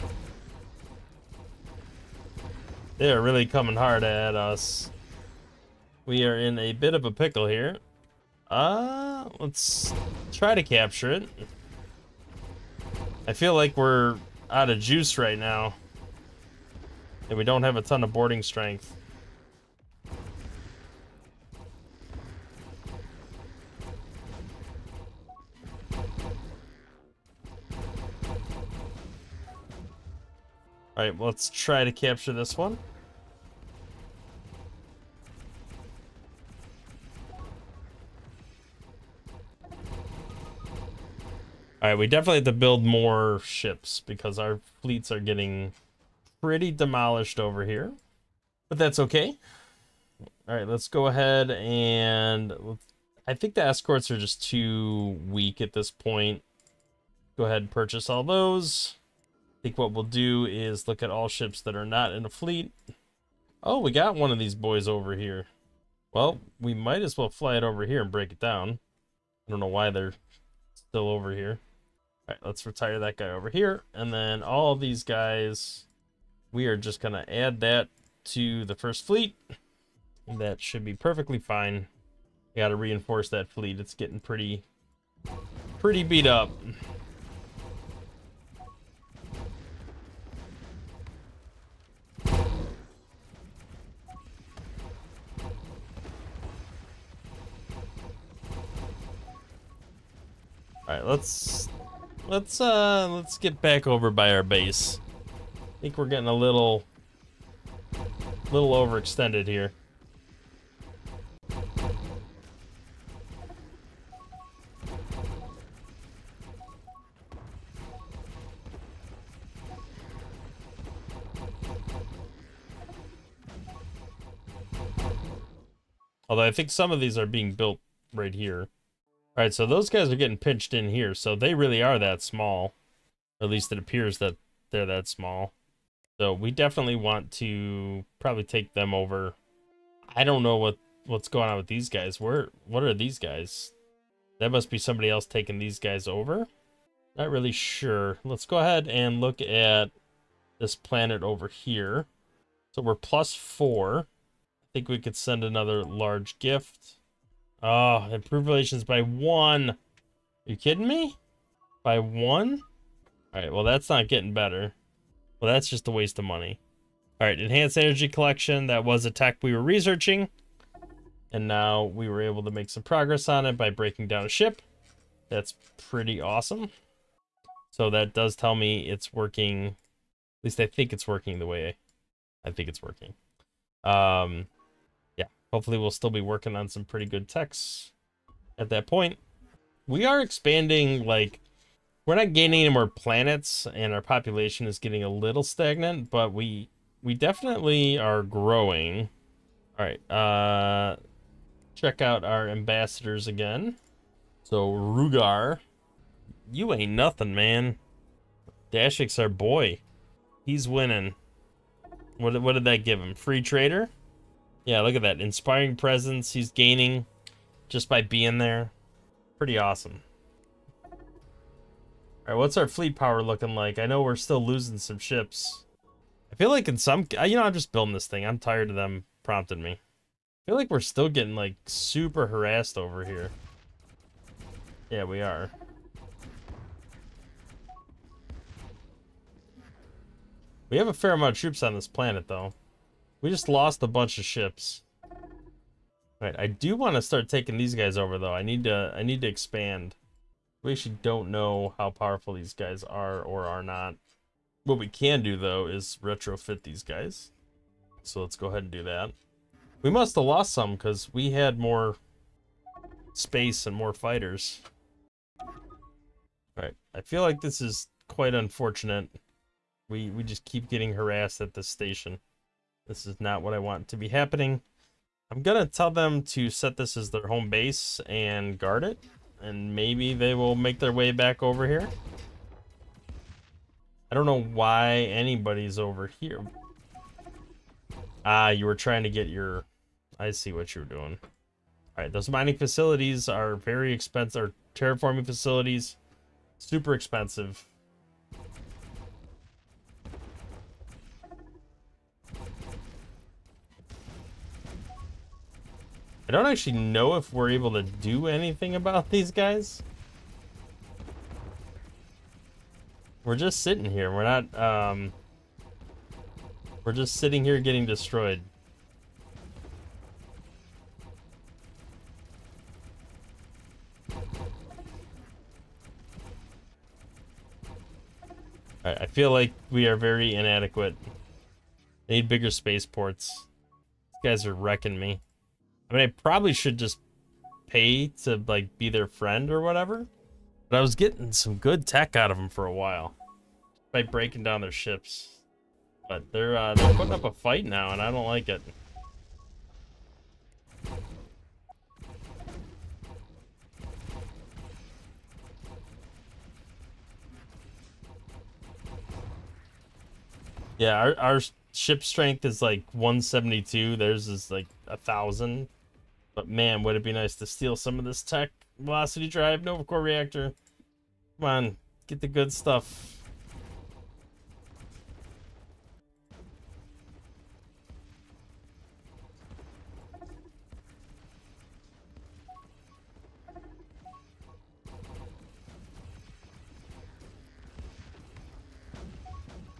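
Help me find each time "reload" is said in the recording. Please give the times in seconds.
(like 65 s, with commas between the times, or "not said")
not said.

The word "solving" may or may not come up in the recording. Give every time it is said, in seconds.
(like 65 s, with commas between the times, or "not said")
not said.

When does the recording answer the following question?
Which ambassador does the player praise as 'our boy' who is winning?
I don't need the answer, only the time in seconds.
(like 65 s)
208 s.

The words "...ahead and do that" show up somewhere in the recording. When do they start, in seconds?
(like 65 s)
258 s.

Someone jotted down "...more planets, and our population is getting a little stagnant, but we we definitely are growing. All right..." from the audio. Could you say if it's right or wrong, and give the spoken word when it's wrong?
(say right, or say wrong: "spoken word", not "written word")
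right.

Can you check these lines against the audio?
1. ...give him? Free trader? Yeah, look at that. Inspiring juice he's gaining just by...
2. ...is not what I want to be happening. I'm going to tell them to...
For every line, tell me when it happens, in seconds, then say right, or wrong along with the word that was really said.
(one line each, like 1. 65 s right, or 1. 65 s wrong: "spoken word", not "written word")
1. 212 s wrong: "presence", not "juice"
2. 273 s right.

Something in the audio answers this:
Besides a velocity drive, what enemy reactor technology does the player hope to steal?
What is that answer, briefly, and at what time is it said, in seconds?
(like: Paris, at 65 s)
Nova Core reactor, at 369 s.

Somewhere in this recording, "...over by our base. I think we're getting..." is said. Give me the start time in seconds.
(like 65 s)
103 s.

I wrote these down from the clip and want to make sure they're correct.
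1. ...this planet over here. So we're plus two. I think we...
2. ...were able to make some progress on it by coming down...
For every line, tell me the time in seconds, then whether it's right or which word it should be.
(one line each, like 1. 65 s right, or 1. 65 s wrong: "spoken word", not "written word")
1. 150 s wrong: "four", not "two"
2. 172 s wrong: "breaking", not "coming".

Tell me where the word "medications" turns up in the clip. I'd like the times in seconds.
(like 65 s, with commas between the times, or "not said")
not said.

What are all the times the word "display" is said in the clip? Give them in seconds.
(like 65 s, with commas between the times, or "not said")
not said.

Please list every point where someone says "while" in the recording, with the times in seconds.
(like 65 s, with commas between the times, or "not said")
342 s.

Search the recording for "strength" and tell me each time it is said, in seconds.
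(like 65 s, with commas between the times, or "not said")
18 s, 362 s.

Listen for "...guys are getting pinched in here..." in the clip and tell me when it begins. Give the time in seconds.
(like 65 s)
129 s.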